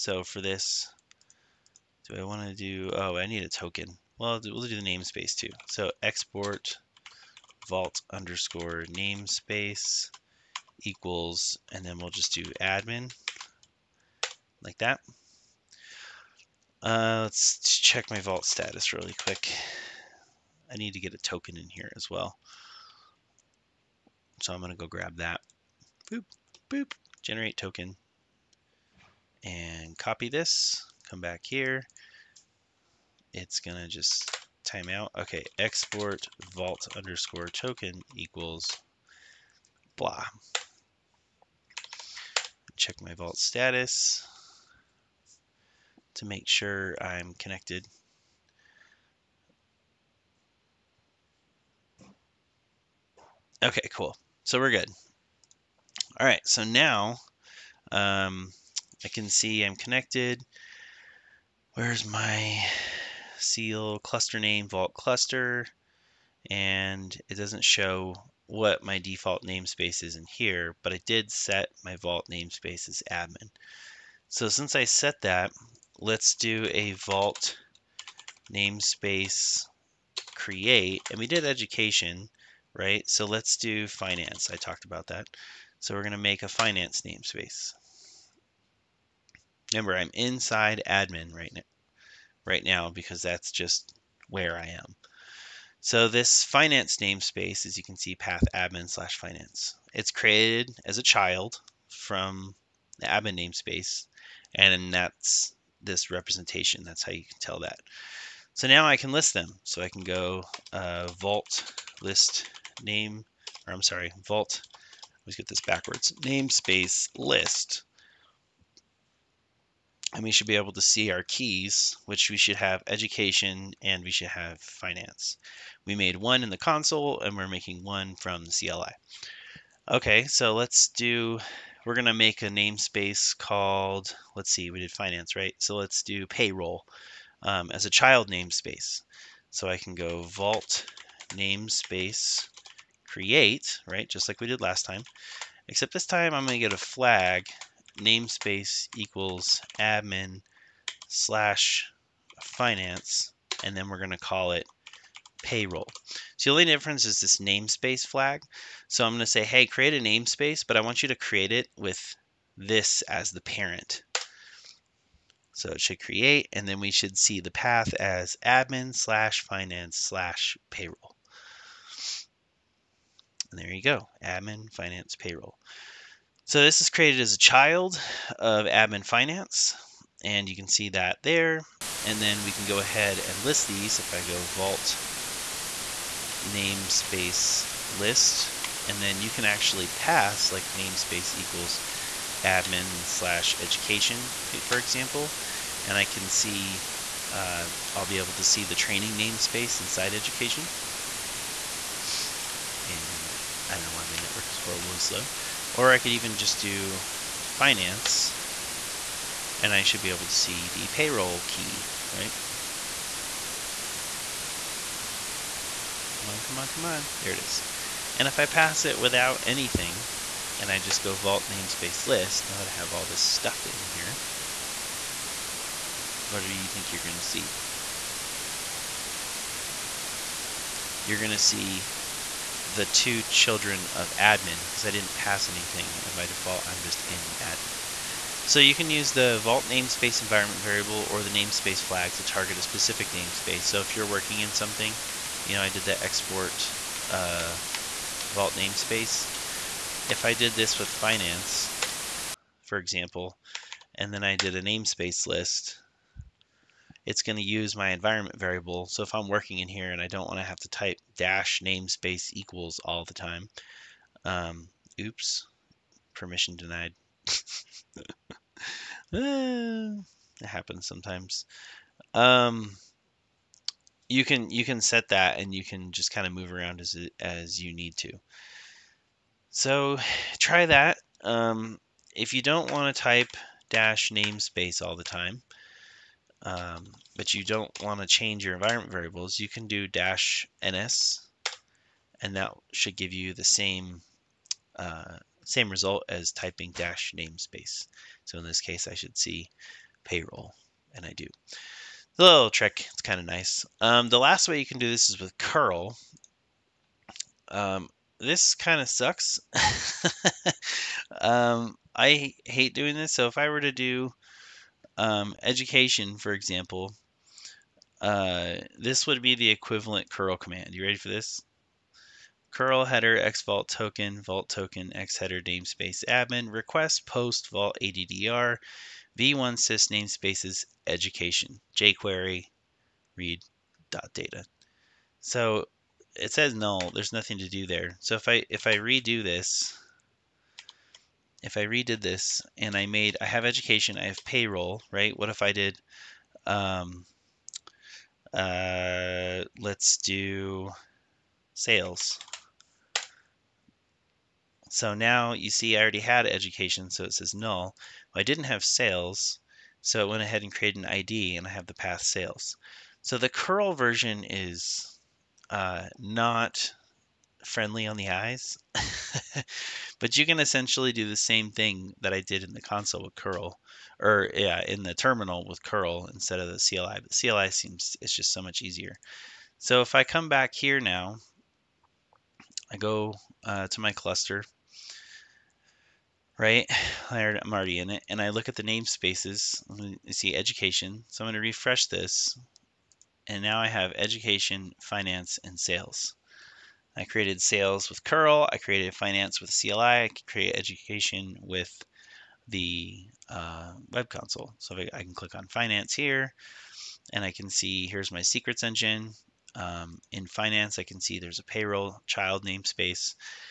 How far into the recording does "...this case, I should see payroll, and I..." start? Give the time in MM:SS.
04:58.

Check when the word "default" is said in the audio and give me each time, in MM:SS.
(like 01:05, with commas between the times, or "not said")
01:08, 03:56.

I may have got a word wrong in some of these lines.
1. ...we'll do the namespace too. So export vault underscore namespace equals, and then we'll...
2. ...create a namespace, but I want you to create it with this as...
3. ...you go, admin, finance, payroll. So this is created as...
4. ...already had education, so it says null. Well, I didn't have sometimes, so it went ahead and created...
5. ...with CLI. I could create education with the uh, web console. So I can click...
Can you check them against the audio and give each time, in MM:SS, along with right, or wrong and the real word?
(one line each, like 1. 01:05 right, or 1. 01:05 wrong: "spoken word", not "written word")
1. 00:04 right
2. 02:39 right
3. 02:53 right
4. 05:55 wrong: "sales", not "sometimes"
5. 06:39 right.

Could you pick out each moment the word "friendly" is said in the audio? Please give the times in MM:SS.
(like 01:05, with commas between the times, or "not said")
06:07.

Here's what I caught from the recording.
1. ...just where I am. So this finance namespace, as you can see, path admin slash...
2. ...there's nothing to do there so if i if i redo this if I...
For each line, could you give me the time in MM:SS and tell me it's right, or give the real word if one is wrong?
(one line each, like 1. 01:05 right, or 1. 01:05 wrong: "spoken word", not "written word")
1. 01:33 right
2. 05:36 right.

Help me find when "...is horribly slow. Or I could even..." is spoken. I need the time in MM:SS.
03:24.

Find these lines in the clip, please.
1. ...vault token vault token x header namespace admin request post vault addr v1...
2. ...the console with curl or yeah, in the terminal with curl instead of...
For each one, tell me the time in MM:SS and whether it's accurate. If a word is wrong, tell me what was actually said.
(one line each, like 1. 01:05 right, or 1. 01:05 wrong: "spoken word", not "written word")
1. 05:23 right
2. 06:12 right.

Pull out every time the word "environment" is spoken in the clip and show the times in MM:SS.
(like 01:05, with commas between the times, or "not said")
04:00, 04:17, 04:48.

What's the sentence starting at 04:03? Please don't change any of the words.
So if you're working in something, you know, I did the export uh, vault namespace.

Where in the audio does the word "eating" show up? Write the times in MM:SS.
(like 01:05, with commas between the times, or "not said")
not said.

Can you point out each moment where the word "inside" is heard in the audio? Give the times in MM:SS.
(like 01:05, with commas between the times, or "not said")
01:30, 03:19.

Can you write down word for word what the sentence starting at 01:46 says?
That's how you can tell that.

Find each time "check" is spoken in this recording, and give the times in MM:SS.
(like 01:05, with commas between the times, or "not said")
00:17, 00:42.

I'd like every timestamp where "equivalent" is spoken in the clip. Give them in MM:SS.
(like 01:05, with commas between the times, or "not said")
05:19.